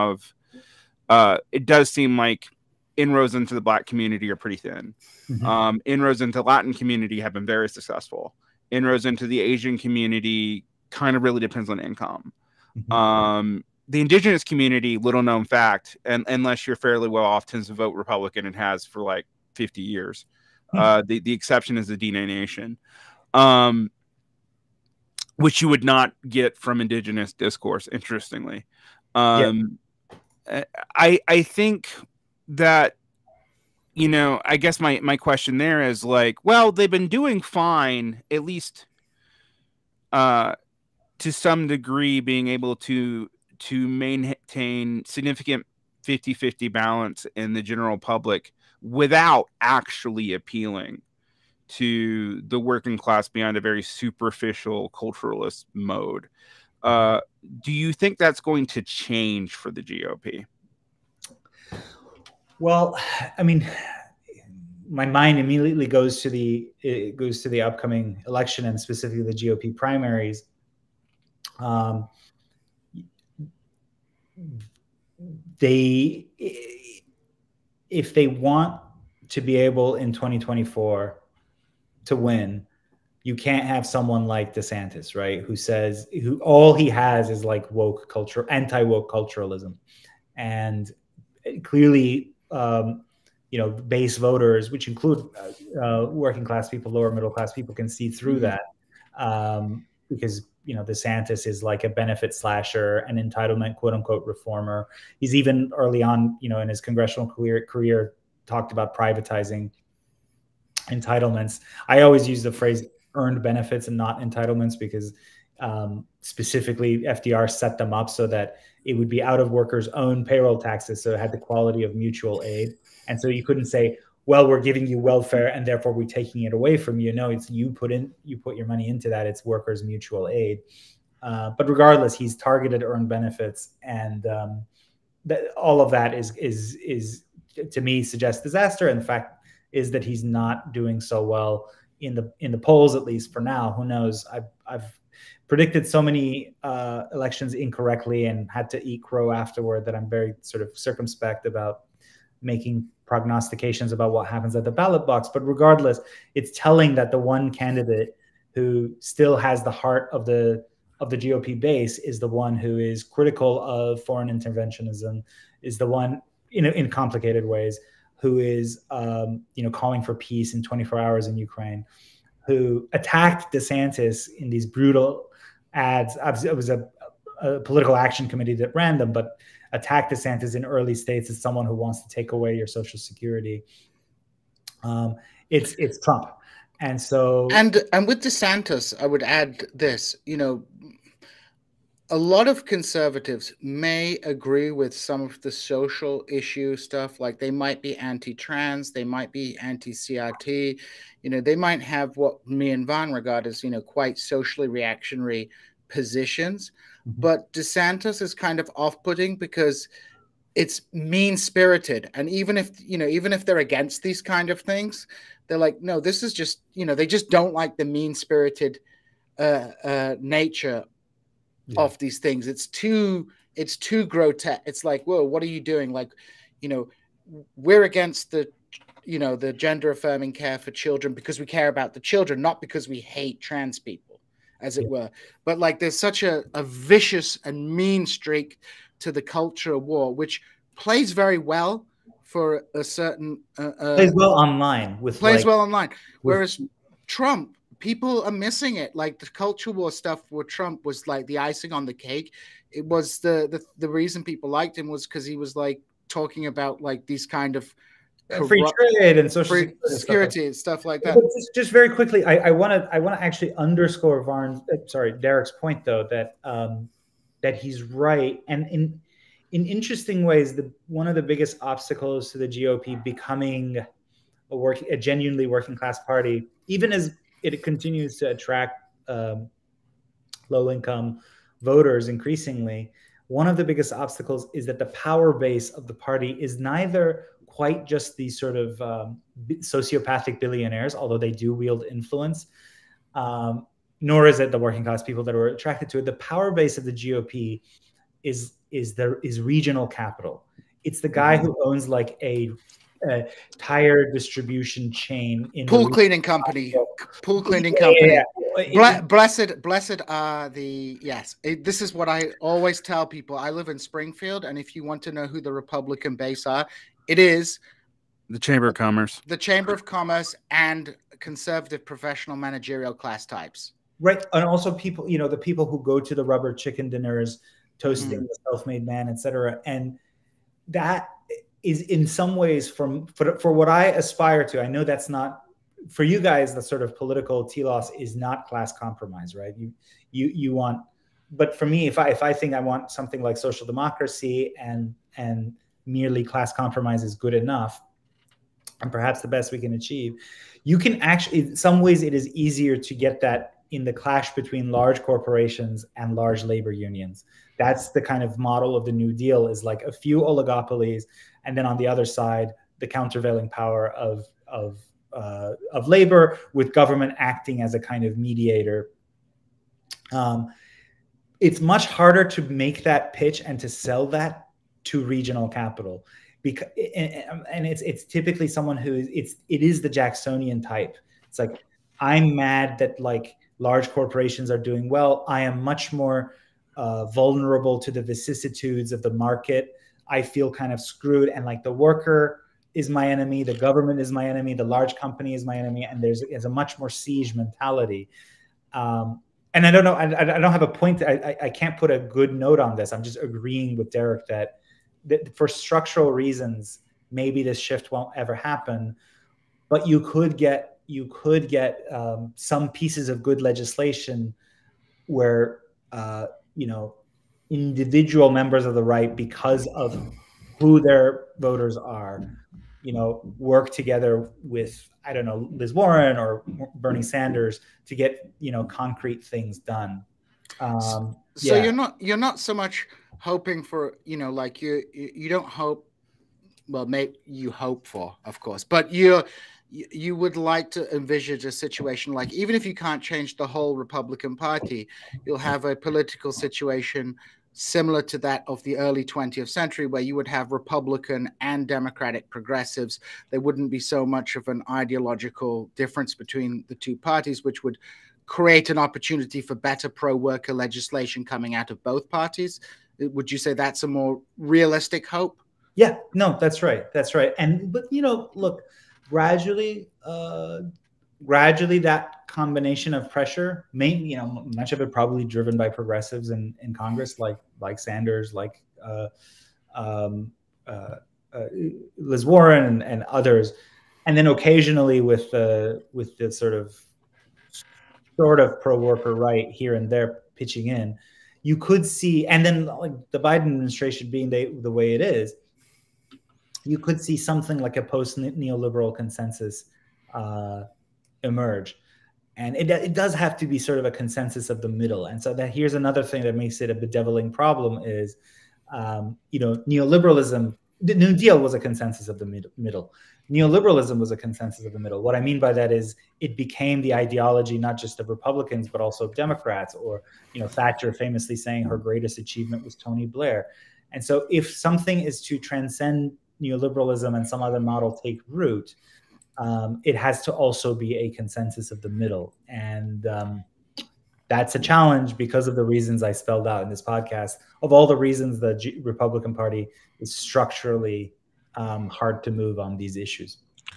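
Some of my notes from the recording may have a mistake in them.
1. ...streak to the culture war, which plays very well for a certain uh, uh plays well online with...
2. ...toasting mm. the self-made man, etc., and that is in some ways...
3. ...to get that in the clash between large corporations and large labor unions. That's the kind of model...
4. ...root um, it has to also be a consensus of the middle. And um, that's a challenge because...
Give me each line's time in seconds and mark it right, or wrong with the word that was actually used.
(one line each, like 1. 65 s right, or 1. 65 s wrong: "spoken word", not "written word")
1. 238 s right
2. 327 s right
3. 352 s right
4. 528 s right.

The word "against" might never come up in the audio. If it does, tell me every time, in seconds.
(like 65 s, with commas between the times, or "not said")
213 s, 227 s.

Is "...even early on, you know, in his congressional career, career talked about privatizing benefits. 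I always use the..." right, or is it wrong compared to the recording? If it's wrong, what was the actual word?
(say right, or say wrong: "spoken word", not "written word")
wrong: "entitlements", not "benefits".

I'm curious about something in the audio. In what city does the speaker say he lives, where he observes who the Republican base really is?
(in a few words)
Springfield.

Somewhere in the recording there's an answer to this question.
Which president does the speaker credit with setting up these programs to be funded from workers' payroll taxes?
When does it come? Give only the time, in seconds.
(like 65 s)
116 s.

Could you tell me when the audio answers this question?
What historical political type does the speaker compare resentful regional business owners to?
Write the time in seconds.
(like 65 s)
379 s.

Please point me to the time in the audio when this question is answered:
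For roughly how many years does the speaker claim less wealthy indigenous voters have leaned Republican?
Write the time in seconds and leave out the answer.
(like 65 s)
19 s.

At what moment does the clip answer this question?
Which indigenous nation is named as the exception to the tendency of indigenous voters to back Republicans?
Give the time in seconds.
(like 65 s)
21 s.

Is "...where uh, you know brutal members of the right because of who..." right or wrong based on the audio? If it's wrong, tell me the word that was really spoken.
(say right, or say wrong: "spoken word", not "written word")
wrong: "individual", not "brutal".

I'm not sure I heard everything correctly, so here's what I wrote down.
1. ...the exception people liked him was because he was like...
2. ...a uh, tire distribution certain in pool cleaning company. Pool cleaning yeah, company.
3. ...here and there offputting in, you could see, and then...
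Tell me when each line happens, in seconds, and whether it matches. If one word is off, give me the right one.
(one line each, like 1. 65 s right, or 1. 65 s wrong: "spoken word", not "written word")
1. 253 s wrong: "reason", not "exception"
2. 302 s wrong: "chain", not "certain"
3. 489 s wrong: "pitching", not "offputting".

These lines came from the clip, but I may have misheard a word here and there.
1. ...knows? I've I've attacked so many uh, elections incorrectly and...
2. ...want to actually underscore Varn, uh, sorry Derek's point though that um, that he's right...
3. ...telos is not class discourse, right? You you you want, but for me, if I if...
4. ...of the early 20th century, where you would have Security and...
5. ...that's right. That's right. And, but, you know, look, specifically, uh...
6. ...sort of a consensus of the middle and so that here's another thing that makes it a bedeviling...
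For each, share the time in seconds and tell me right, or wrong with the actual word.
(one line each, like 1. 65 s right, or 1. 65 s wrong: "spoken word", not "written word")
1. 143 s wrong: "predicted", not "attacked"
2. 262 s right
3. 337 s wrong: "compromise", not "discourse"
4. 448 s wrong: "Republican", not "Security"
5. 466 s wrong: "gradually", not "specifically"
6. 503 s right.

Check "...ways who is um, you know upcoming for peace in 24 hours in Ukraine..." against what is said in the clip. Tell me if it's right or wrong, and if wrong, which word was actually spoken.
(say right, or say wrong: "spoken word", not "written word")
wrong: "calling", not "upcoming".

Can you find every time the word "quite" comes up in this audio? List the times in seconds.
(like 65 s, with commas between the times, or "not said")
203 s, 287 s.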